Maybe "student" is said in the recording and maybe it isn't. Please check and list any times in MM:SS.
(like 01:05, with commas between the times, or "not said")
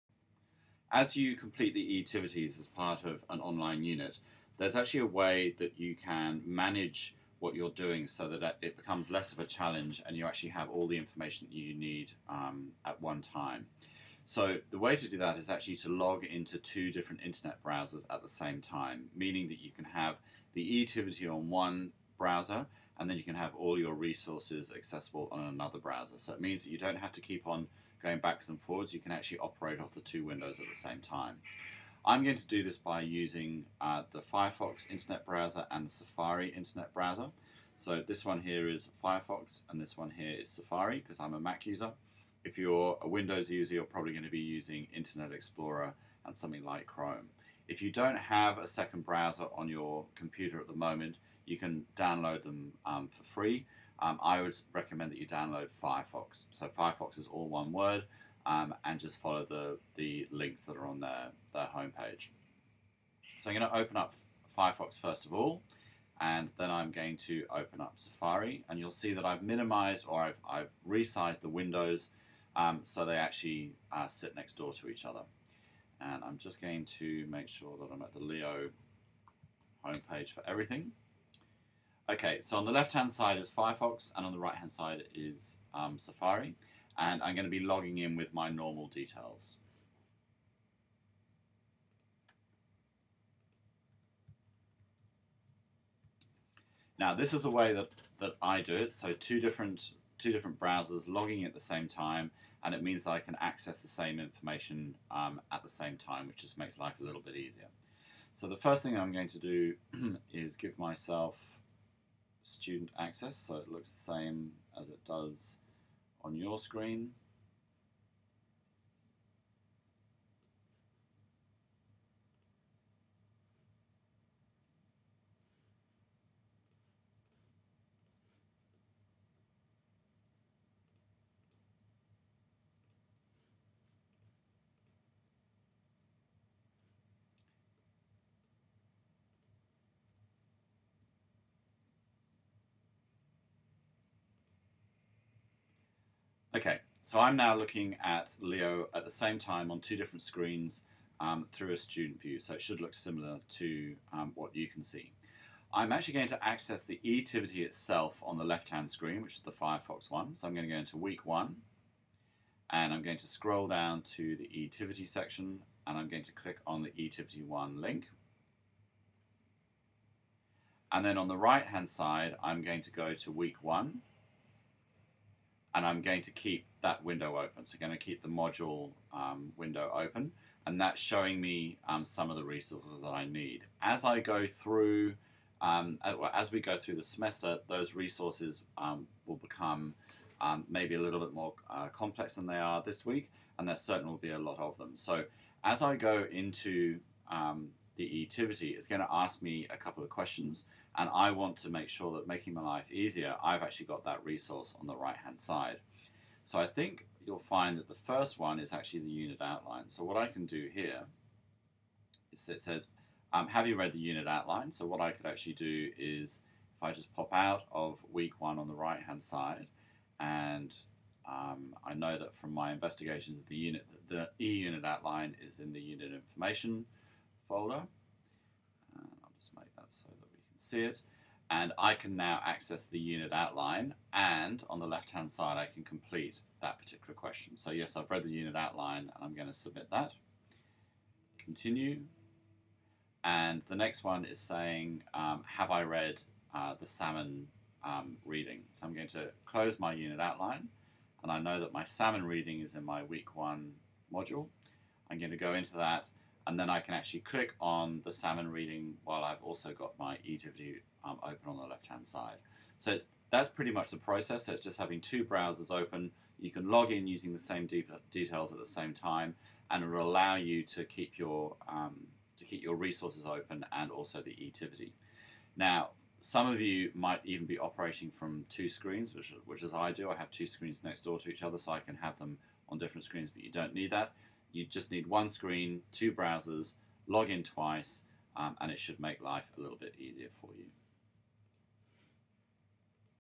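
01:52, 02:31.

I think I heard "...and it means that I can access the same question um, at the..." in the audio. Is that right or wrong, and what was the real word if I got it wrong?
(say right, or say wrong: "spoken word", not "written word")
wrong: "information", not "question".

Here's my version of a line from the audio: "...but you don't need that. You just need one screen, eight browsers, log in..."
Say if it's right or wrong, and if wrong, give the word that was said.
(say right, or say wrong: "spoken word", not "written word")
wrong: "two", not "eight".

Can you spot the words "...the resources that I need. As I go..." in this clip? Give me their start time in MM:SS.
03:02.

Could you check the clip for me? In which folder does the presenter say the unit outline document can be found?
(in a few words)
Unit information folder.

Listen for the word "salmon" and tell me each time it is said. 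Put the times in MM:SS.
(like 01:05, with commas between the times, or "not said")
04:06, 04:11, 04:18.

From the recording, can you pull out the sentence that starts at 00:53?
Um, I would recommend that you download Firefox.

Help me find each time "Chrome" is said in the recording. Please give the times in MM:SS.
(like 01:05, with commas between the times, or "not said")
00:46.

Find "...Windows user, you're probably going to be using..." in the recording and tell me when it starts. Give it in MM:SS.
00:43.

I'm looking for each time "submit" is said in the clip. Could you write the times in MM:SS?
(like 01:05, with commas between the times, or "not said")
03:59.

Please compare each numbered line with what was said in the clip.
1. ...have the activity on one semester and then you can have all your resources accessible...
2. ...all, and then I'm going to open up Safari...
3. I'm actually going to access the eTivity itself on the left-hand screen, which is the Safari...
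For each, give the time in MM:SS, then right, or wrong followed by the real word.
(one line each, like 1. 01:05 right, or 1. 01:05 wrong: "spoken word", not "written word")
1. 00:19 wrong: "browser", not "semester"
2. 01:05 right
3. 02:35 wrong: "Firefox", not "Safari".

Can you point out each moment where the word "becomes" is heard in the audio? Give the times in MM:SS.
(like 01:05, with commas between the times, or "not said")
00:08, 03:09.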